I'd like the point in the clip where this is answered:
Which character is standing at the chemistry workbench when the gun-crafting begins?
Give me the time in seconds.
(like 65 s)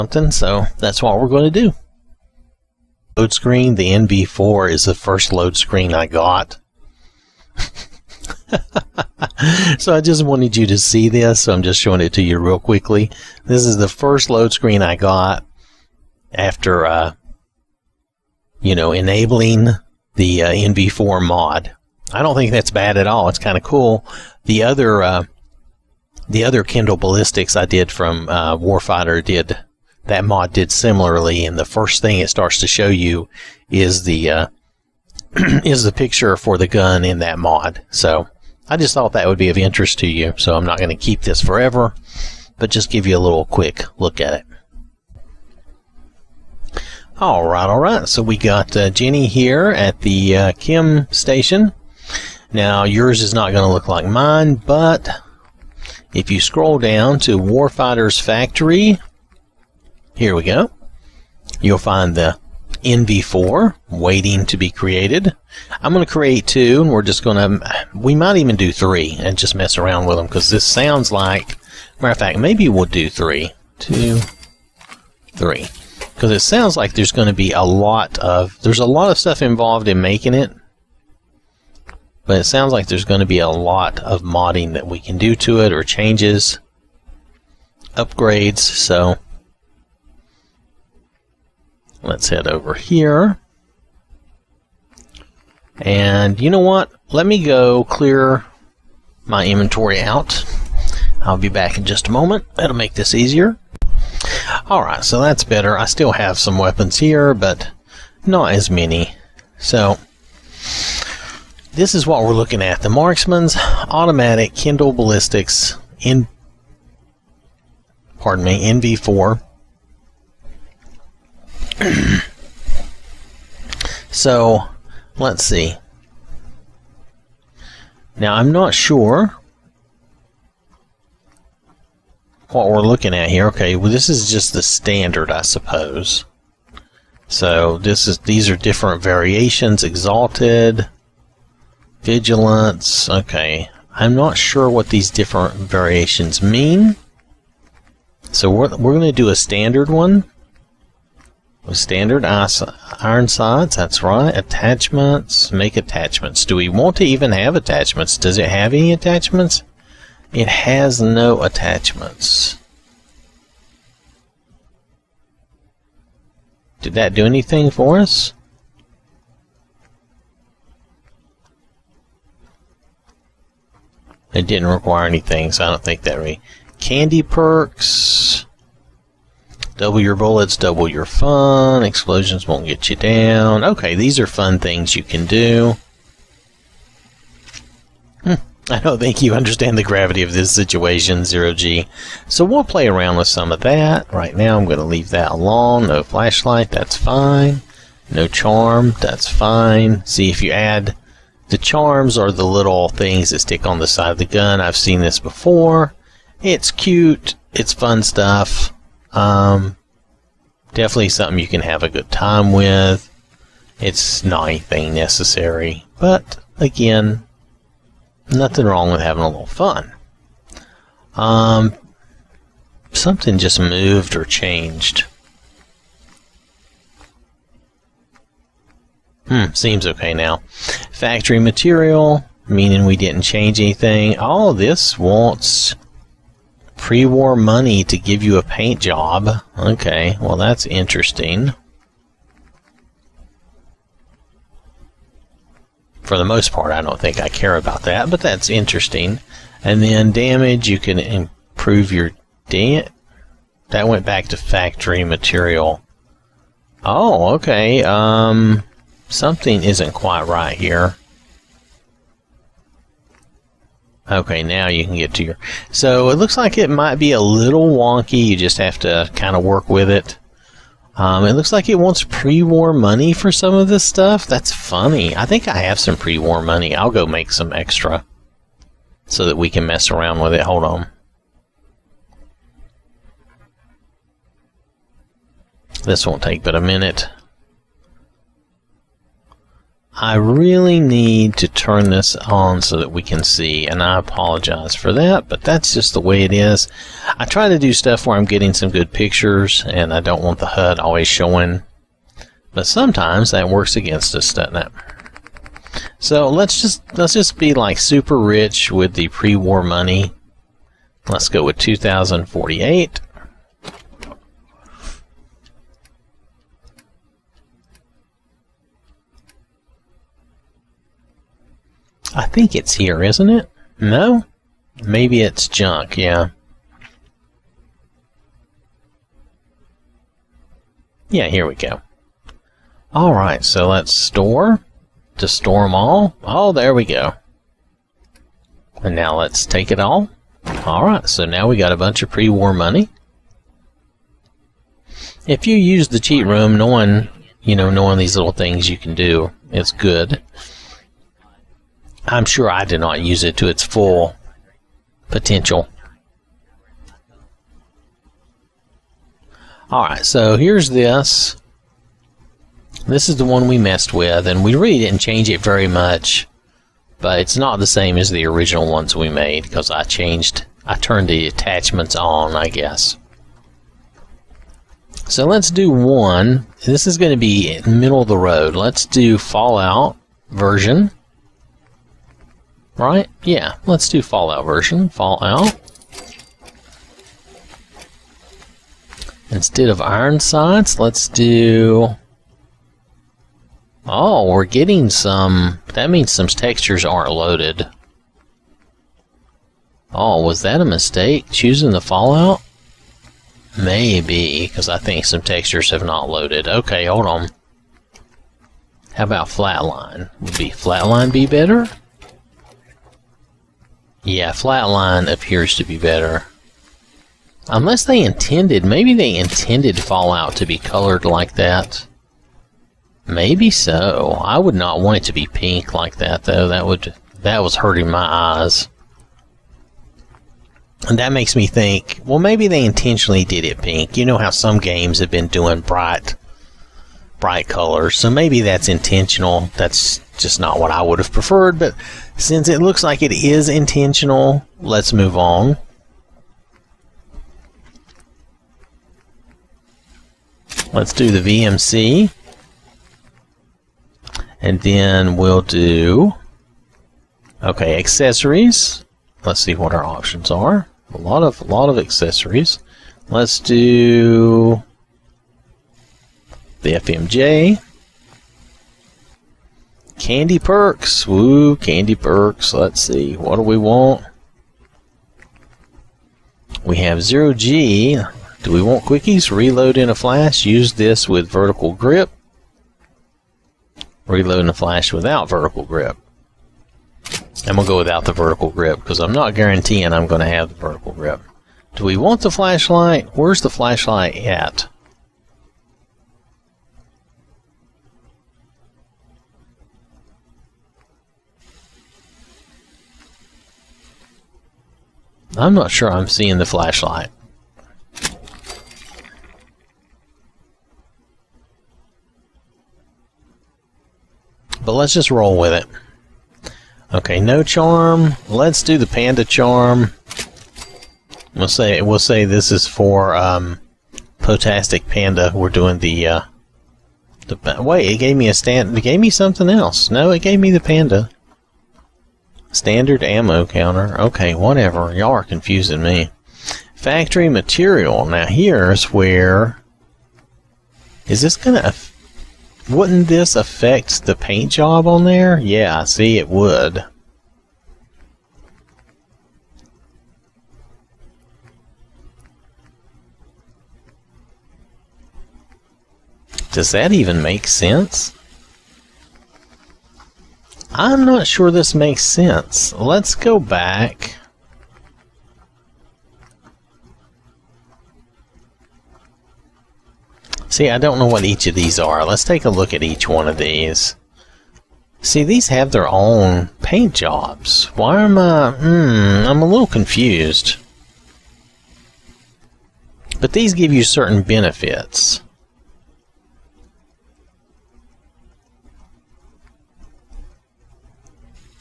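48 s.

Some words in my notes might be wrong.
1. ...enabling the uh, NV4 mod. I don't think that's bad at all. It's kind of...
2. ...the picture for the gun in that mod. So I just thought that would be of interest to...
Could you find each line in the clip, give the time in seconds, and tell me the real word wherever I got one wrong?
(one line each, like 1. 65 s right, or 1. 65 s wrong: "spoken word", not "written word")
1. 18 s right
2. 35 s right.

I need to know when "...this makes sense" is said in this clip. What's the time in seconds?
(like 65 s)
561 s.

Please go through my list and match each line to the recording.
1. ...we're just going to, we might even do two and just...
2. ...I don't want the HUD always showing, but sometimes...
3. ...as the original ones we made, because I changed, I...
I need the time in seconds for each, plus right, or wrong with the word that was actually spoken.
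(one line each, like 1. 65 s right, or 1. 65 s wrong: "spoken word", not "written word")
1. 66 s wrong: "three", not "two"
2. 299 s right
3. 367 s right.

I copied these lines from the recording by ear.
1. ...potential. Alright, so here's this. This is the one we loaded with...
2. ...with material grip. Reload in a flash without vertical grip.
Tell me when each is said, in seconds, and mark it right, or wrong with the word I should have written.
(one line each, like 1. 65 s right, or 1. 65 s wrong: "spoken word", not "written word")
1. 355 s wrong: "messed", not "loaded"
2. 481 s wrong: "vertical", not "material".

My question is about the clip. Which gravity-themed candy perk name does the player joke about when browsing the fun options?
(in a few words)
Zero G.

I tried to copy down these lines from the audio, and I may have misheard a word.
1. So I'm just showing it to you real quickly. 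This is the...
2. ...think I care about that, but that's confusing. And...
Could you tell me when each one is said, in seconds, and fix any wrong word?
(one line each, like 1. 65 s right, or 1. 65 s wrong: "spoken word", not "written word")
1. 11 s right
2. 246 s wrong: "interesting", not "confusing".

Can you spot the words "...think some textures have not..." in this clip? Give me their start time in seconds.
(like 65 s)
404 s.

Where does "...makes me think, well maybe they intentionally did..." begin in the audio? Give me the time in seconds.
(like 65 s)
431 s.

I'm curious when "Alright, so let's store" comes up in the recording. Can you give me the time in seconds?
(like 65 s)
332 s.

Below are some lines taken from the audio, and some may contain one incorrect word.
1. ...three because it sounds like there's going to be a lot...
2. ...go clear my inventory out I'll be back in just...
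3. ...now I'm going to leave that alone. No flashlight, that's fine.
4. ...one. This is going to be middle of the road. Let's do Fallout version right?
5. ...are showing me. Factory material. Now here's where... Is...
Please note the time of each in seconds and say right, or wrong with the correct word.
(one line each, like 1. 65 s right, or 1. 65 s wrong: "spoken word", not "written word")
1. 75 s right
2. 97 s right
3. 194 s right
4. 375 s right
5. 535 s wrong: "confusing", not "showing".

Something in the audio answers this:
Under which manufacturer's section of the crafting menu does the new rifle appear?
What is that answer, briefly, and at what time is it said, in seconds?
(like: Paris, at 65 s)
Warfighter's Factory, at 57 s.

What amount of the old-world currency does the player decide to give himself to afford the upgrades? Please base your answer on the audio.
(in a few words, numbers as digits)
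2048.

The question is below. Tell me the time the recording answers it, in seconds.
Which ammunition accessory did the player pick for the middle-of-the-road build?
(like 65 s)
466 s.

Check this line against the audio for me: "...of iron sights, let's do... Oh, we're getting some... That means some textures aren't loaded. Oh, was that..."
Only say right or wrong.
right.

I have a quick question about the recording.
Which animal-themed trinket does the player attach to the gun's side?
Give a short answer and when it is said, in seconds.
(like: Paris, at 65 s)
panda charm, at 518 s.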